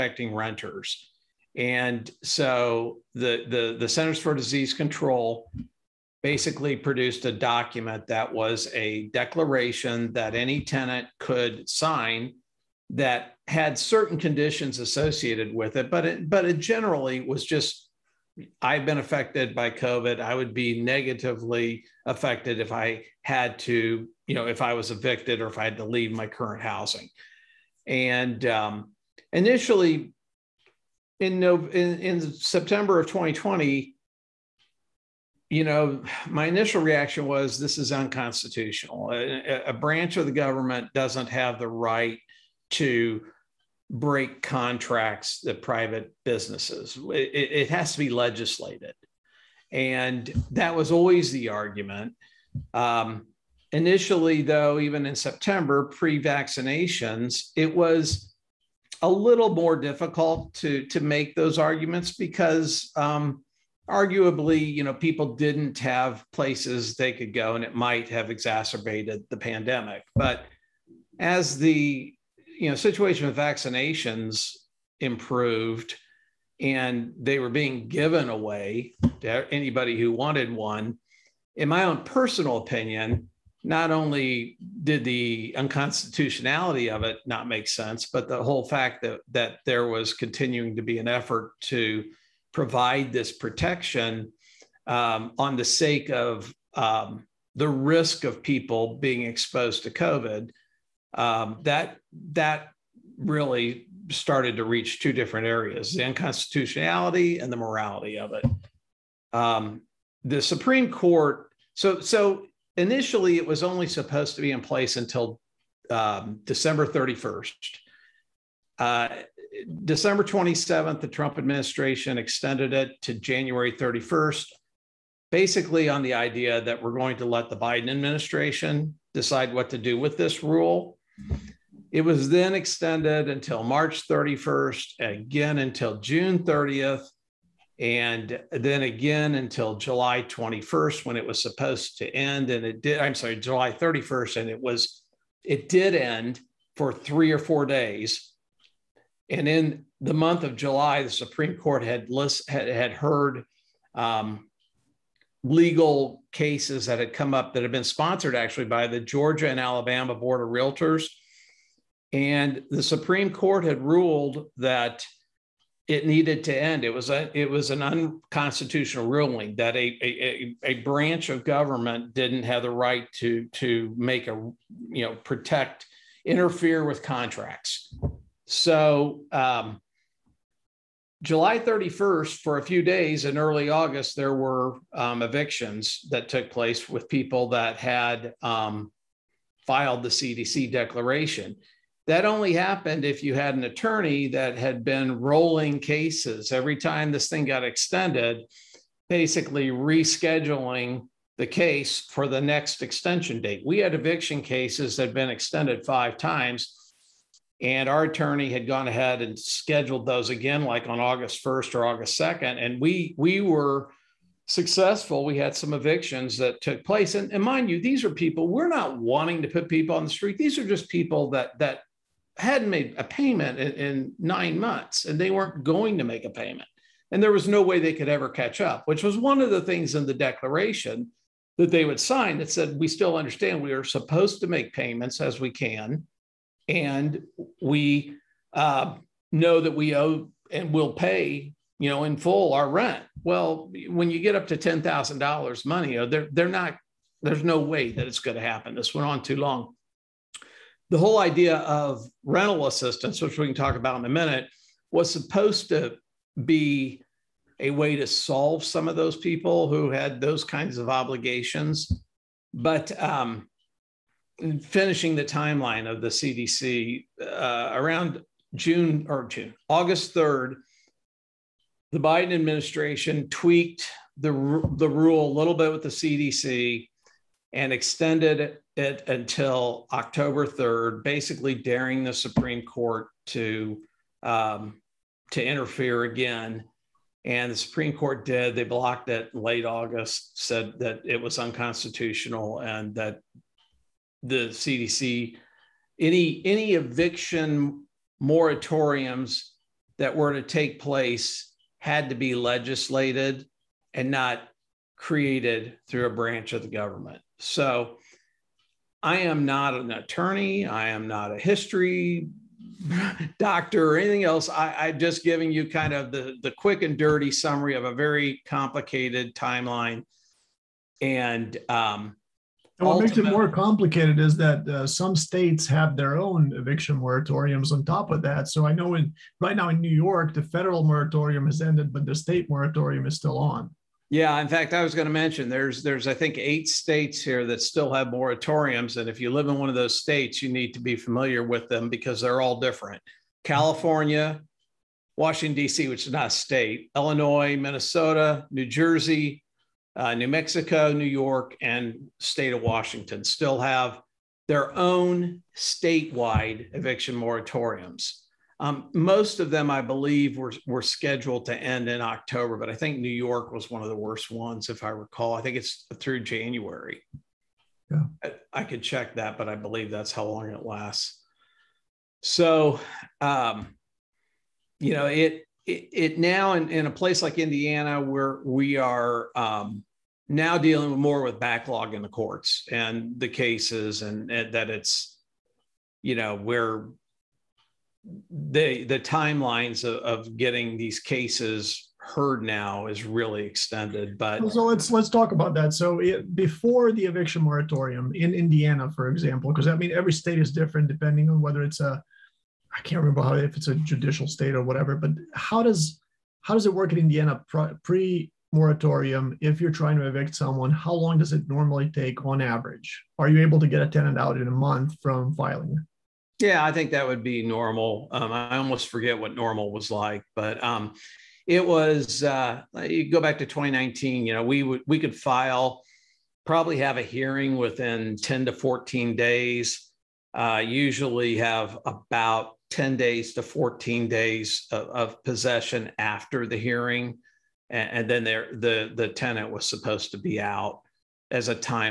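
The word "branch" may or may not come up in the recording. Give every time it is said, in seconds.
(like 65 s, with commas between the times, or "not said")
39 s, 170 s, 306 s.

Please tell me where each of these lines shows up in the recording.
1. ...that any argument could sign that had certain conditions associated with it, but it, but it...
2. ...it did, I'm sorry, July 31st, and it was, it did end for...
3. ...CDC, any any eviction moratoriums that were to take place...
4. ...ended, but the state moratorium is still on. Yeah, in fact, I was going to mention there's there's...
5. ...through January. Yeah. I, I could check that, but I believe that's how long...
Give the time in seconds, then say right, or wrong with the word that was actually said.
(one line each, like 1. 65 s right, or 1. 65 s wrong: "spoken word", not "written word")
1. 10 s wrong: "tenant", not "argument"
2. 142 s right
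3. 294 s right
4. 331 s right
5. 365 s right.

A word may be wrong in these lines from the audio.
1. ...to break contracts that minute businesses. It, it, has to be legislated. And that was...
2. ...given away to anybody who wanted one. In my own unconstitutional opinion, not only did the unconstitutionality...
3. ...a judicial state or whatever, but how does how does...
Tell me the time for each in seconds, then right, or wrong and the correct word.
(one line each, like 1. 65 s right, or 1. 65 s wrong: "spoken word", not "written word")
1. 42 s wrong: "private", not "minute"
2. 77 s wrong: "personal", not "unconstitutional"
3. 403 s right.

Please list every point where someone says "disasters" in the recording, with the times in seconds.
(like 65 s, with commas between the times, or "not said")
not said.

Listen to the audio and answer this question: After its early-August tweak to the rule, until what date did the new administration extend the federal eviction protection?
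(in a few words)
October 3rd.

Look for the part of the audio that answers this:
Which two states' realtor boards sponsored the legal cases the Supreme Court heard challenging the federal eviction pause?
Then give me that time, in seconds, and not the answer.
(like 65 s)
158 s.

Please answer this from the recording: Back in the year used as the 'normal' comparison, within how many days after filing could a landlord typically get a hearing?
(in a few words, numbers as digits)
10 to 14 days.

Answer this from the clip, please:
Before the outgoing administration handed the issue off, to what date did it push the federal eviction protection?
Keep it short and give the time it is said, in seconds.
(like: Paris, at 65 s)
January 31st, at 123 s.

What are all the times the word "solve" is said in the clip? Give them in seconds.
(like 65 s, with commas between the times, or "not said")
258 s.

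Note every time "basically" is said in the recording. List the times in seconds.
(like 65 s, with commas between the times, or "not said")
6 s, 125 s, 199 s, 281 s.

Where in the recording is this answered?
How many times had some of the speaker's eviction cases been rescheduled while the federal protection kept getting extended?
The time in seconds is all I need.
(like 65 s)
205 s.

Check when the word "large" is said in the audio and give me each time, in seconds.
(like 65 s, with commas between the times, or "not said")
not said.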